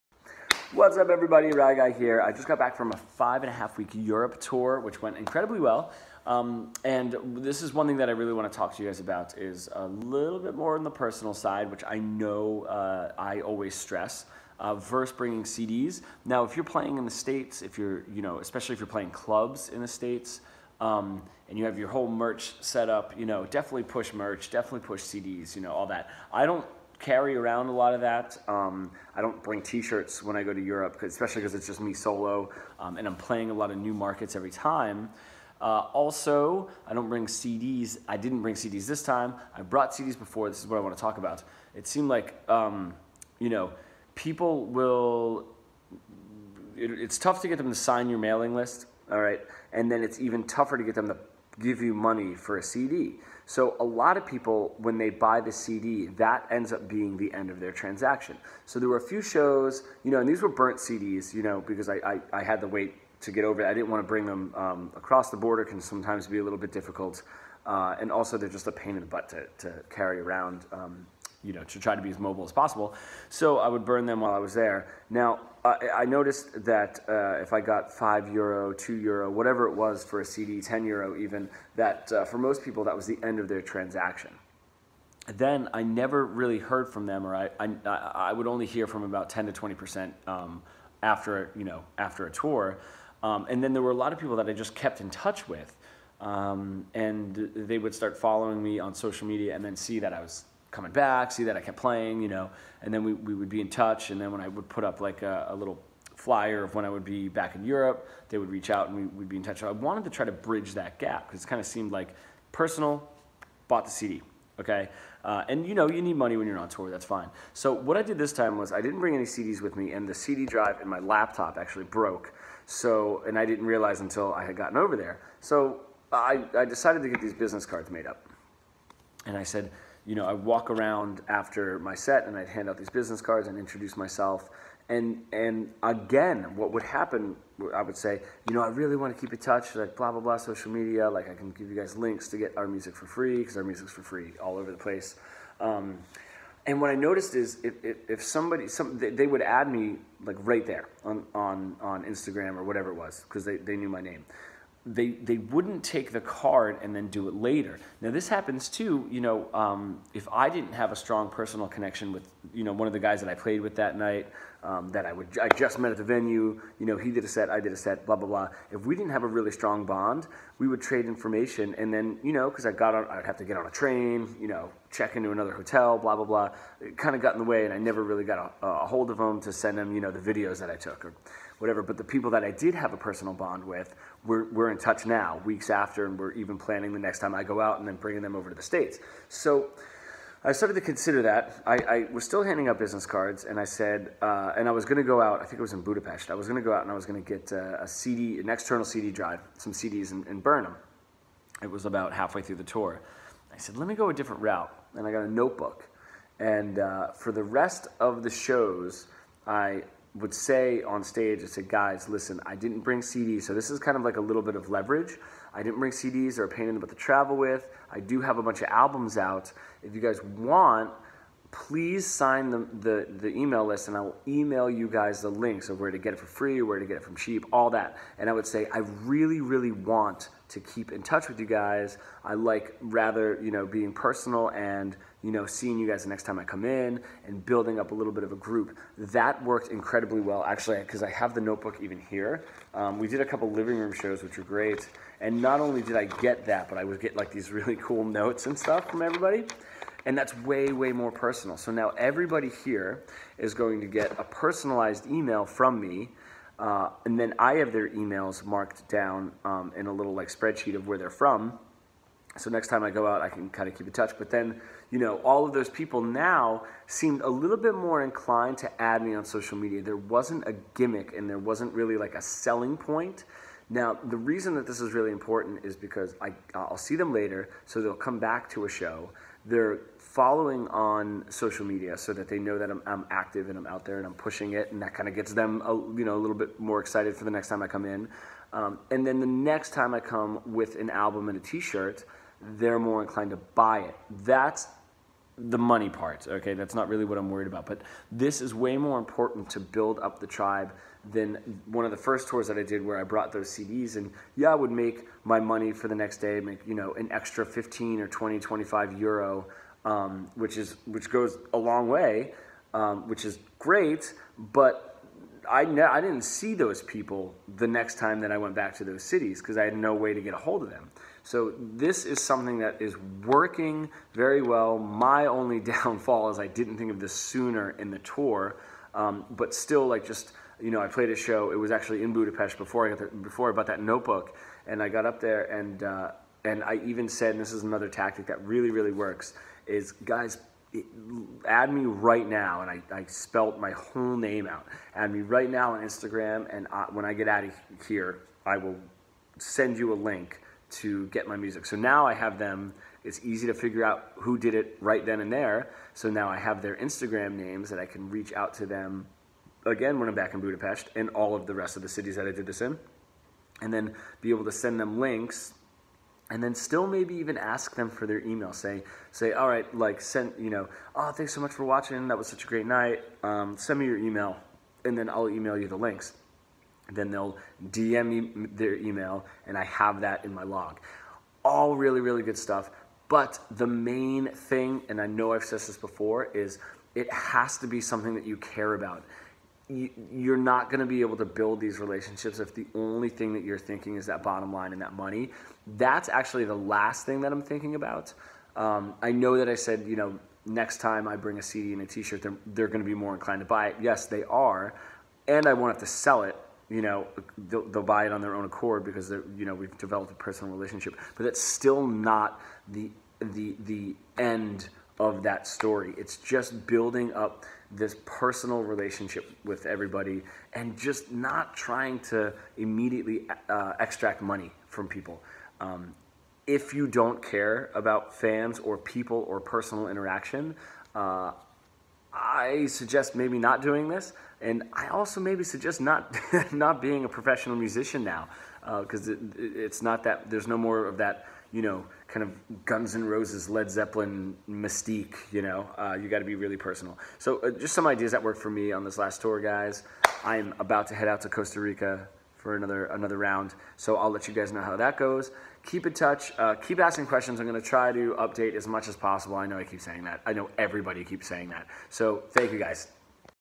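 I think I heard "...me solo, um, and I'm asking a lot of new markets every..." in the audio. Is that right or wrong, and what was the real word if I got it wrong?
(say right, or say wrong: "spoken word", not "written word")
wrong: "playing", not "asking".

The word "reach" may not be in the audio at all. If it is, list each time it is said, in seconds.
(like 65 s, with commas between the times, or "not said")
108 s, 358 s.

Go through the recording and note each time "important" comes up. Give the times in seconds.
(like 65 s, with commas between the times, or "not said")
275 s, 298 s.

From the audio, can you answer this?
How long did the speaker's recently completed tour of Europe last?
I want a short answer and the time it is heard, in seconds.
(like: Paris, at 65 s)
5 and a half weeks, at 2 s.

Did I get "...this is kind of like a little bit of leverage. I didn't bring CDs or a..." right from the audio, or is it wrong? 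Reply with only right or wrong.
right.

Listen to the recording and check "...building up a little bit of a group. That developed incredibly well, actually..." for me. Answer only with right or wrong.
wrong.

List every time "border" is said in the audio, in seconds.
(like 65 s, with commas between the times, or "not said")
65 s.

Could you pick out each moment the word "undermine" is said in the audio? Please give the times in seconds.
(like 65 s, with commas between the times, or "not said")
not said.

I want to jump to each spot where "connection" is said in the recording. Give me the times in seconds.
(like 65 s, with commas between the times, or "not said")
161 s.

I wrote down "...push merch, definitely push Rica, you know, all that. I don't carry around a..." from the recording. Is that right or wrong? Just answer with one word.
wrong.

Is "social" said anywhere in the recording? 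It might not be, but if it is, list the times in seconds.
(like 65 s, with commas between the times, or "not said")
98 s, 140 s, 269 s, 281 s.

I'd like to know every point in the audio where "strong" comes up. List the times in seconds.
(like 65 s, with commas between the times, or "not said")
160 s, 169 s.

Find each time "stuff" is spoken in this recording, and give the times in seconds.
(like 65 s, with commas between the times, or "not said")
248 s, 382 s.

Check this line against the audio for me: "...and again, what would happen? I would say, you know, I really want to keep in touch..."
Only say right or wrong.
right.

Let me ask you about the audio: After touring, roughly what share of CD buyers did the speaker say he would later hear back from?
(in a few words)
10 to 20%.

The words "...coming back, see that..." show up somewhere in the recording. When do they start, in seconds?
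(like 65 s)
100 s.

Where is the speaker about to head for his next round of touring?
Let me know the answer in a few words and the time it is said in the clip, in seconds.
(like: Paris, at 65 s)
Costa Rica, at 451 s.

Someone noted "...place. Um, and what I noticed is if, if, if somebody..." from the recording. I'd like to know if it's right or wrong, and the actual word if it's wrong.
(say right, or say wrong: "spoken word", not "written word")
right.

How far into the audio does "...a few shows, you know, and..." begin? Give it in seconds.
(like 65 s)
58 s.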